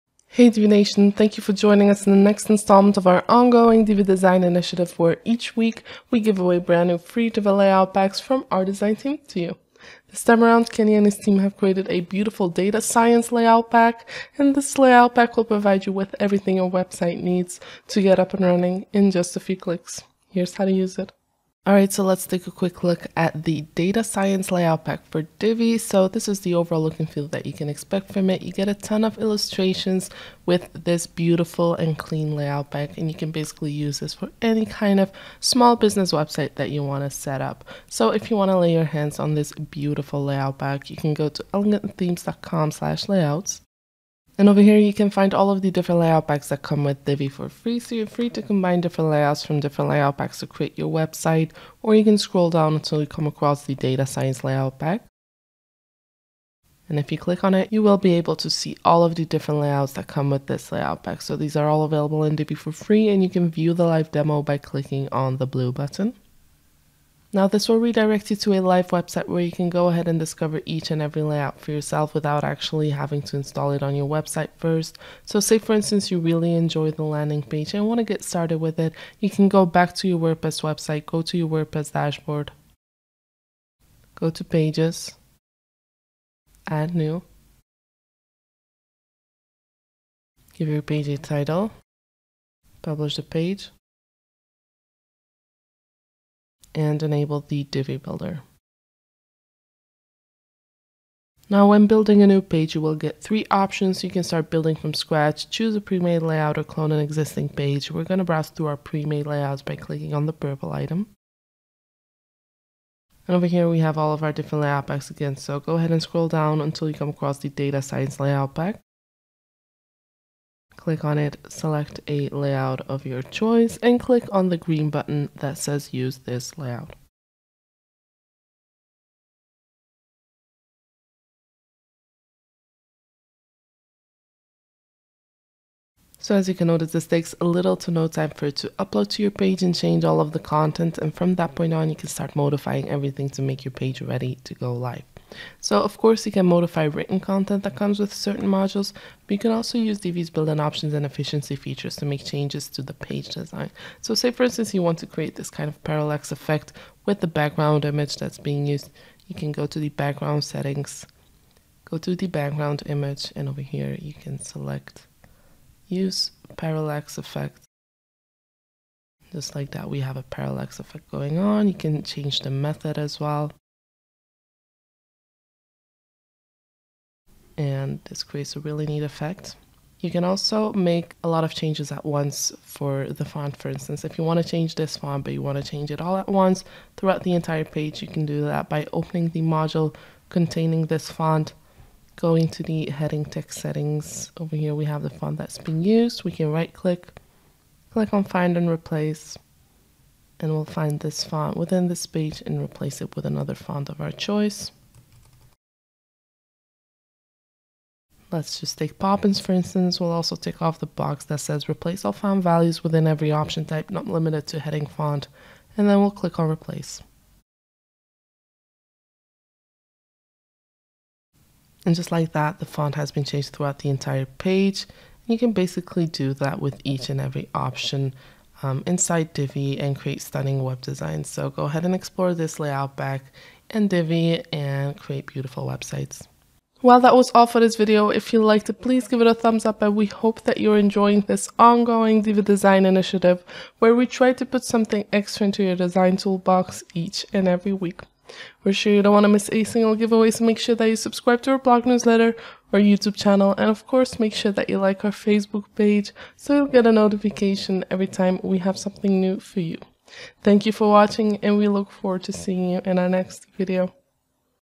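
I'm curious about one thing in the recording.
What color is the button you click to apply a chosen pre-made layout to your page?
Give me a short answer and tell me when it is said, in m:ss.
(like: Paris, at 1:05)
Green, at 2:04.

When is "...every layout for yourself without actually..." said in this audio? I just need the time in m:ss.
1:11.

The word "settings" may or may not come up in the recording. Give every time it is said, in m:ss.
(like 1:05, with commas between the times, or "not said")
2:40, 3:13.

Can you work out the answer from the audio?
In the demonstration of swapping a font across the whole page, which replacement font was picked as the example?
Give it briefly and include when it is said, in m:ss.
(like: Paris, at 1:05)
Poppins, at 3:28.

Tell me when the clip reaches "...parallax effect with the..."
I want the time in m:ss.
2:35.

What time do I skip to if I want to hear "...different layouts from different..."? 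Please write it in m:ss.
0:48.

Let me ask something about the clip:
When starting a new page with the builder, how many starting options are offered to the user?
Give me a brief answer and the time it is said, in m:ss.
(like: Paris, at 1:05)
3, at 1:43.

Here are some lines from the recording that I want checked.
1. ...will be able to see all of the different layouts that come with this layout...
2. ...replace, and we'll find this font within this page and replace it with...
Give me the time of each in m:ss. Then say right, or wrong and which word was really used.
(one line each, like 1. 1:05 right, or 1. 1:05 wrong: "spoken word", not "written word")
1. 0:57 right
2. 3:18 right.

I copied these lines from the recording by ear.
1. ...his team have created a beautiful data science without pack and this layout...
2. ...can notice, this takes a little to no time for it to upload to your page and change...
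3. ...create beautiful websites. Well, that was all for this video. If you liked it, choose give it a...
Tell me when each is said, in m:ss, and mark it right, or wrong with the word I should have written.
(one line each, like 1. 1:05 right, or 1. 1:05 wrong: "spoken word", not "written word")
1. 0:11 wrong: "layout", not "without"
2. 2:16 right
3. 3:54 wrong: "please", not "choose".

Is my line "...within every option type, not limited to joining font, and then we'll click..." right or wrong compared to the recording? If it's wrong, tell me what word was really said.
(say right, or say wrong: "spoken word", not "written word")
wrong: "heading", not "joining".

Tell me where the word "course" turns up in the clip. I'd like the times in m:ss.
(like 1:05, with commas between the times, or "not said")
2:25, 4:13.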